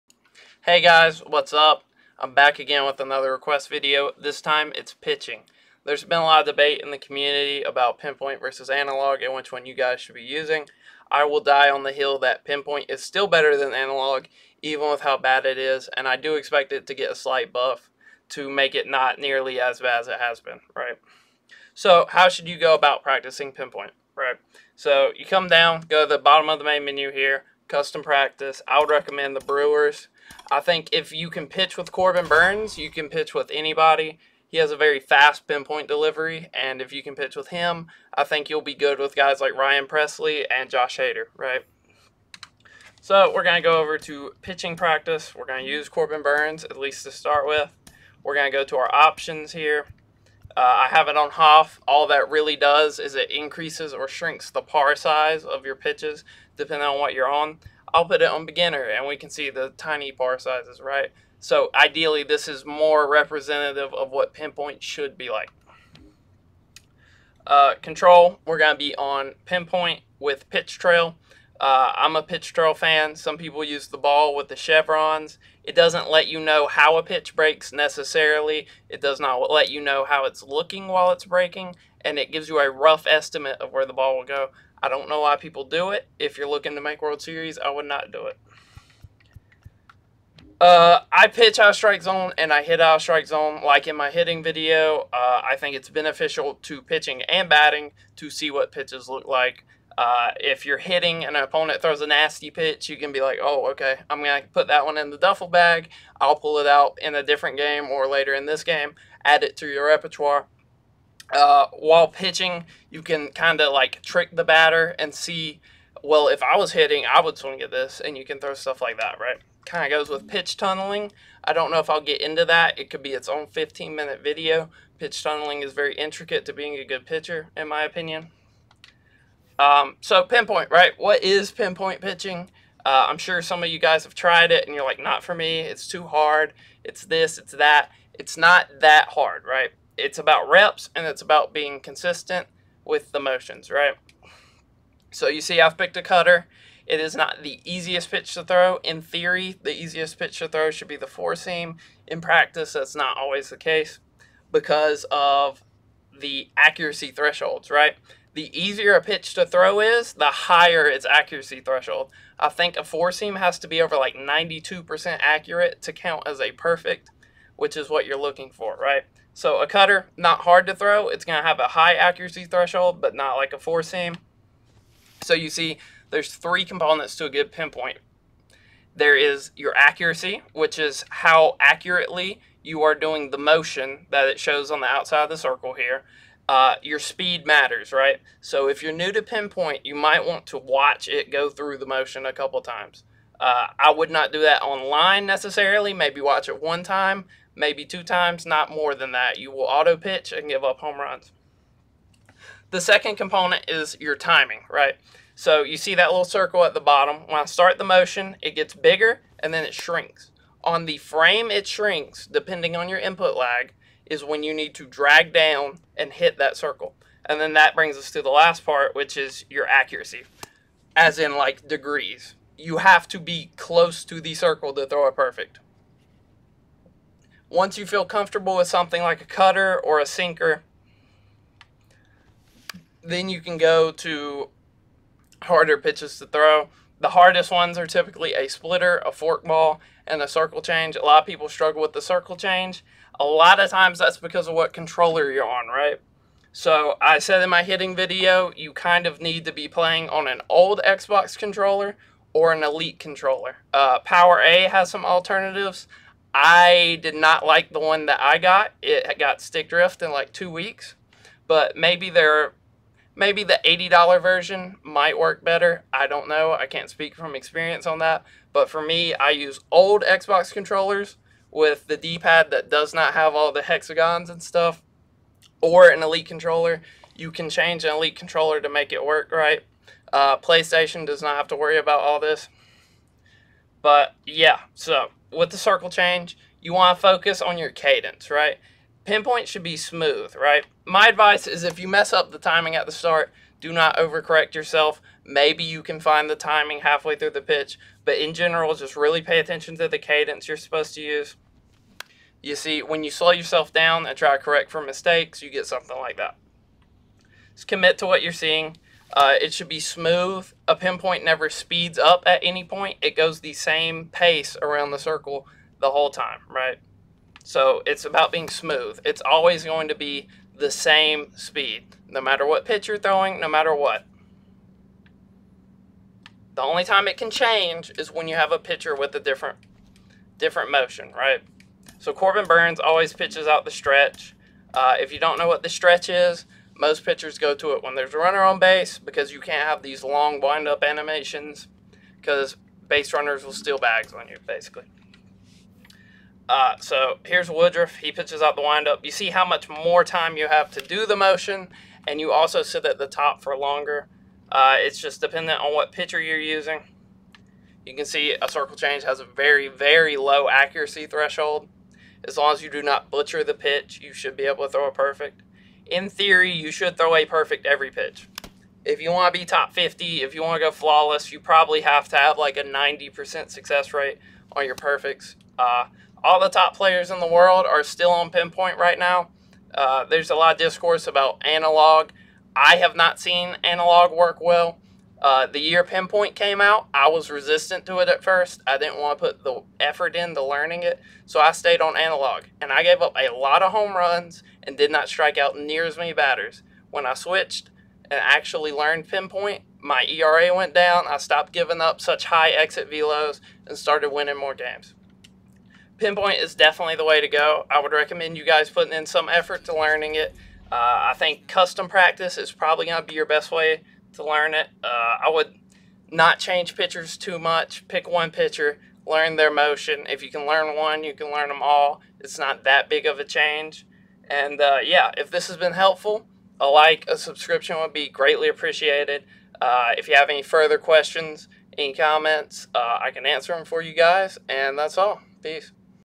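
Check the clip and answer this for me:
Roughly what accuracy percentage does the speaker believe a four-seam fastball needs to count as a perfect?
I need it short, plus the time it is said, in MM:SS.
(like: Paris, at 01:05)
92%, at 02:44.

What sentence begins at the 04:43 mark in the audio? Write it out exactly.
But yeah, so with the circle change, you want to focus on your cadence, right?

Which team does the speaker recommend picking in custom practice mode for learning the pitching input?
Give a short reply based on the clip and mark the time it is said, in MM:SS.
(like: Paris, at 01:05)
Brewers, at 00:29.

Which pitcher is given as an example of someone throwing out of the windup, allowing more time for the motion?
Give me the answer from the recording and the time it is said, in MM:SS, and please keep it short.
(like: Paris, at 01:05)
Woodruff, at 05:47.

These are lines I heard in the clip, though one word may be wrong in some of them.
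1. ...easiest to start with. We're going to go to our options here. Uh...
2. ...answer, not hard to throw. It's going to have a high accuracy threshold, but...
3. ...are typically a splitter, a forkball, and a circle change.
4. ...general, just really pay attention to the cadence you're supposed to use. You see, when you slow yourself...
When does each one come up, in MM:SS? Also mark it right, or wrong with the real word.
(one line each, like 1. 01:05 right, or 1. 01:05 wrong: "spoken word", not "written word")
1. 00:46 wrong: "least", not "easiest"
2. 02:49 wrong: "cutter", not "answer"
3. 03:57 right
4. 04:58 right.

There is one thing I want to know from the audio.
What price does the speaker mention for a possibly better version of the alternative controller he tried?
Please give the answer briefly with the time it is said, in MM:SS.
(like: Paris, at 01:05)
$80, at 04:23.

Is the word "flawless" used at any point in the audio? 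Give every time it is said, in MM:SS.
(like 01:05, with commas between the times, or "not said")
06:10.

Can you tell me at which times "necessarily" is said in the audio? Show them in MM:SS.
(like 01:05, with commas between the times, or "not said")
01:17, 03:15.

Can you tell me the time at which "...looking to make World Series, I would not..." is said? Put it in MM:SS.
01:26.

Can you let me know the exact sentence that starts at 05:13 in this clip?
It goes the same pace around the circle the whole time, right?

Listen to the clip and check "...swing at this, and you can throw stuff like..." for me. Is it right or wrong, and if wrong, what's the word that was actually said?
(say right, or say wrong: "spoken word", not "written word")
right.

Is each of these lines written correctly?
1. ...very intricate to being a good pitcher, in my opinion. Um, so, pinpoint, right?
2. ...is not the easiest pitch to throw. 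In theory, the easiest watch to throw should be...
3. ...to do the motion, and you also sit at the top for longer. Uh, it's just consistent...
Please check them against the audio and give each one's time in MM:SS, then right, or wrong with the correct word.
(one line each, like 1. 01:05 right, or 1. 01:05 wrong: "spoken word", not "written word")
1. 02:05 right
2. 02:26 wrong: "pitch", not "watch"
3. 05:50 wrong: "dependent", not "consistent".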